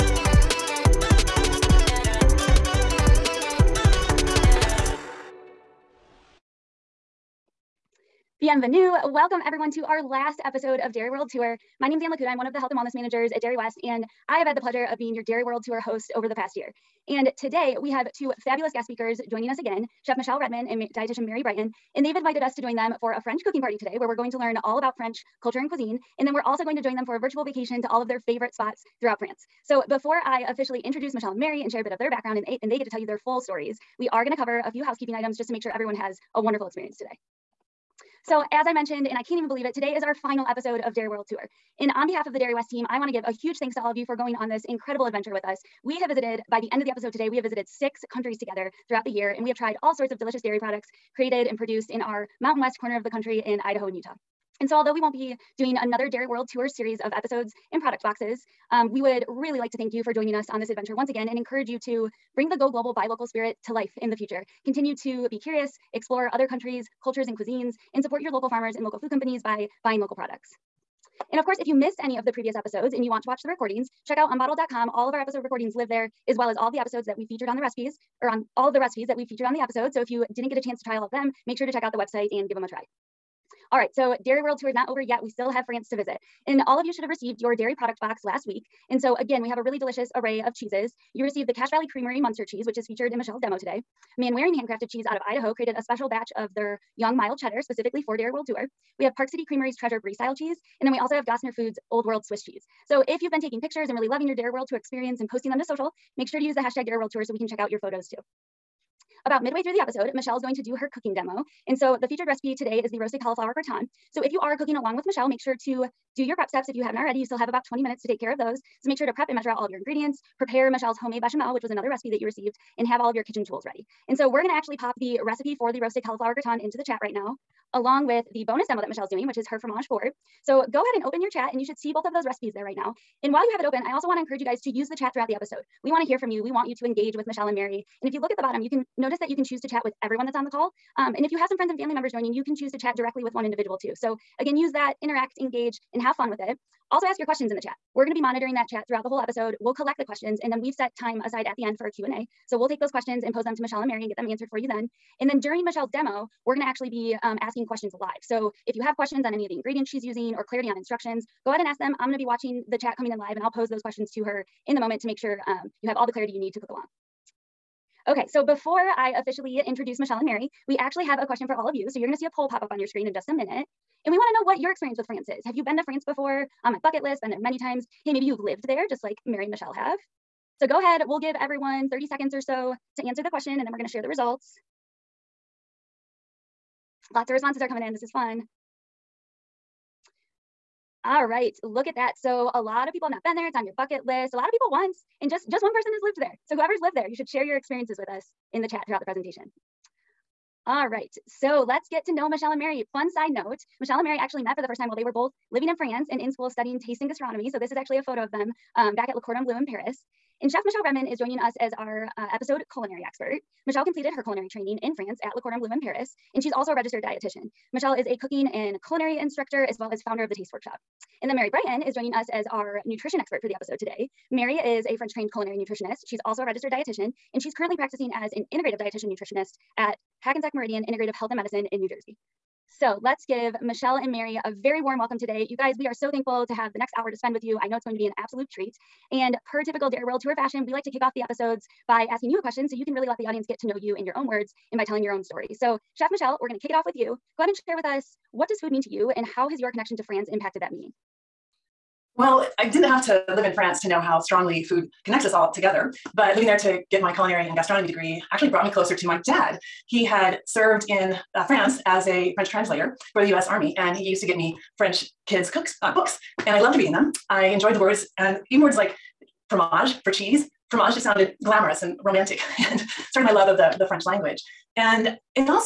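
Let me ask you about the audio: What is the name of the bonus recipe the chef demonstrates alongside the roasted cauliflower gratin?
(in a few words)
Fromage fort.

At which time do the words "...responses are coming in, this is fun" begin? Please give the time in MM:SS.
03:07.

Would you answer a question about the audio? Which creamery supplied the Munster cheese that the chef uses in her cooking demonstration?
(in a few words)
Cache Valley Creamery.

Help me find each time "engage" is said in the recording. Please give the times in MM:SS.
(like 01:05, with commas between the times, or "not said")
02:16, 02:25.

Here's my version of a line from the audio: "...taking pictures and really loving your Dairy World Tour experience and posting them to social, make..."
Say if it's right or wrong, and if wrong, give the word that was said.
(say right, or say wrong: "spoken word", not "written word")
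right.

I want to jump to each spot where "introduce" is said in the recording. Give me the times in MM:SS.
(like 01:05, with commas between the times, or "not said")
00:30, 02:49.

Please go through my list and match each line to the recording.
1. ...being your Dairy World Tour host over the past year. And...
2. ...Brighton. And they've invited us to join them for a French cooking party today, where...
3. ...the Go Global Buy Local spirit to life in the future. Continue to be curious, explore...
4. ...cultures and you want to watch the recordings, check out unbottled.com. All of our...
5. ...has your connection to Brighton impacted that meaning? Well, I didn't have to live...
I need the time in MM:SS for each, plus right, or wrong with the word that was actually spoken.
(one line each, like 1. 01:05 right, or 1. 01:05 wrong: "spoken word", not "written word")
1. 00:14 right
2. 00:21 right
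3. 01:02 right
4. 01:12 wrong: "episodes", not "cultures"
5. 04:09 wrong: "France", not "Brighton".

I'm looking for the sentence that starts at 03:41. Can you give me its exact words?
And then Mary Brighton is joining us as our nutrition expert for the episode today.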